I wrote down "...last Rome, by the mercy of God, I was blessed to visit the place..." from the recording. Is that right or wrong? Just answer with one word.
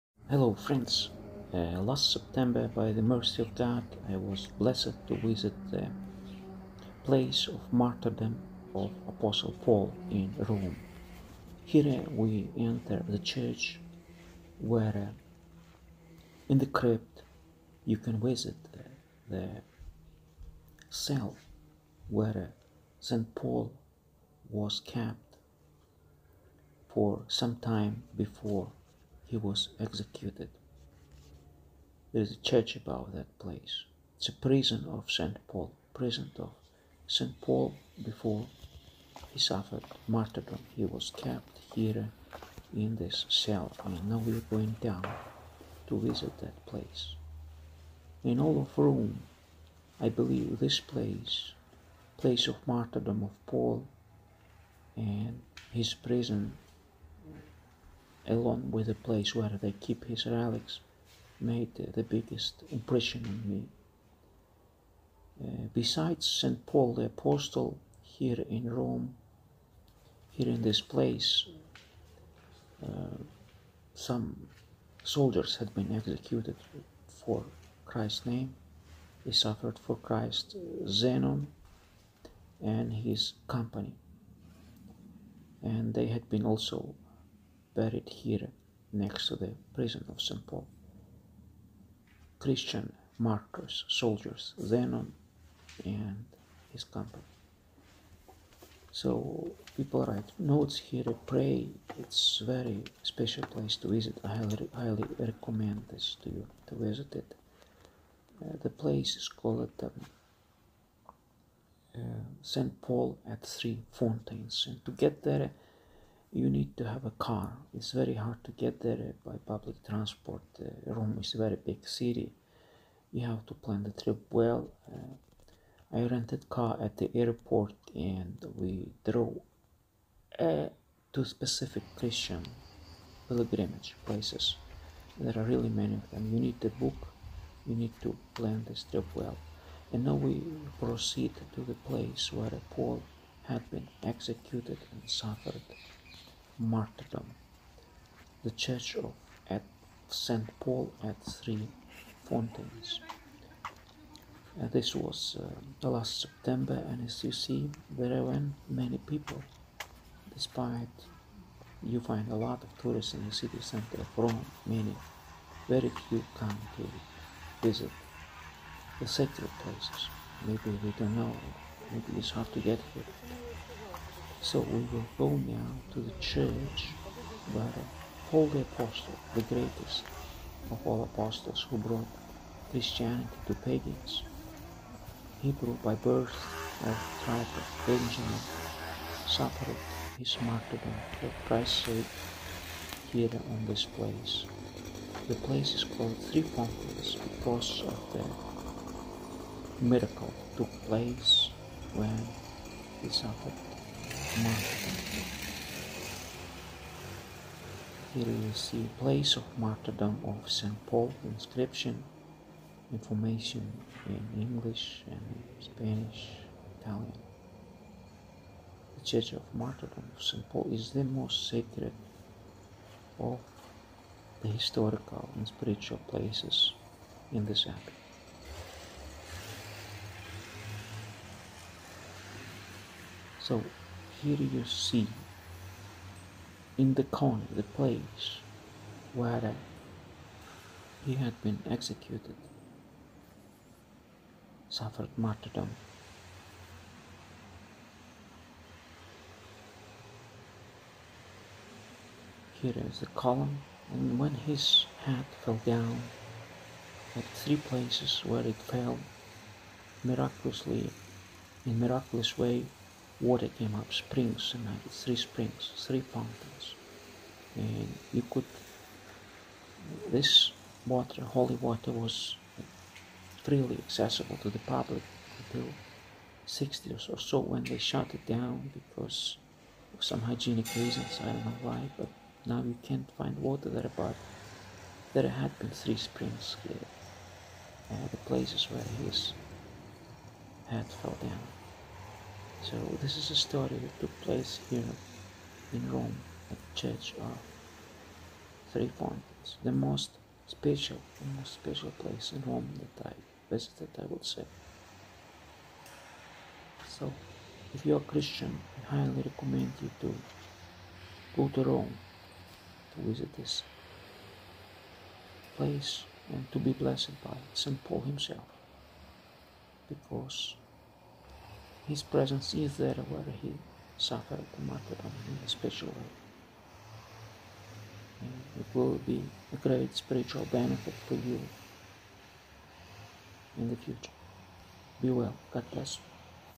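wrong.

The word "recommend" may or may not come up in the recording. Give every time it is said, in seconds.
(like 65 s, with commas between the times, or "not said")
105 s, 309 s.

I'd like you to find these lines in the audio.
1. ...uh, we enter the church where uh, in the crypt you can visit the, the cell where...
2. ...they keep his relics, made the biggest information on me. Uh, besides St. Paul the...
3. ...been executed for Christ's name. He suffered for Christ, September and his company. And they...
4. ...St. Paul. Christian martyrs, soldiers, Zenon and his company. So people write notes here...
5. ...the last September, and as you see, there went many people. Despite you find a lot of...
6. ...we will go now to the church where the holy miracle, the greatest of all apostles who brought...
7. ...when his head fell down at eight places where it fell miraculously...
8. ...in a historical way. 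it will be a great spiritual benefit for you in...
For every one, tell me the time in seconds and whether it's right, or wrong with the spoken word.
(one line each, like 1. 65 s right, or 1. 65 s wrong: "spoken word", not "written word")
1. 11 s right
2. 59 s wrong: "impression", not "information"
3. 75 s wrong: "Zenon", not "September"
4. 90 s right
5. 155 s right
6. 174 s wrong: "apostle", not "miracle"
7. 254 s wrong: "three", not "eight"
8. 325 s wrong: "special", not "historical".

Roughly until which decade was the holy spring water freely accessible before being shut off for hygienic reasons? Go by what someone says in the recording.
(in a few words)
60s.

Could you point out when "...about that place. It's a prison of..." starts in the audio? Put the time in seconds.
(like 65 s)
32 s.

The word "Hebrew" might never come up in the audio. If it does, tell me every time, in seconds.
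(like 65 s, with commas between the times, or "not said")
185 s.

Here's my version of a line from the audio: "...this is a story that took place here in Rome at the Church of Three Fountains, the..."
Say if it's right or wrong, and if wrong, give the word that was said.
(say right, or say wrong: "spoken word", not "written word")
right.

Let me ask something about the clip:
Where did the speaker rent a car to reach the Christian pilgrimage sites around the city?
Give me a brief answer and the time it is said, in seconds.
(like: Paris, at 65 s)
At the airport, at 126 s.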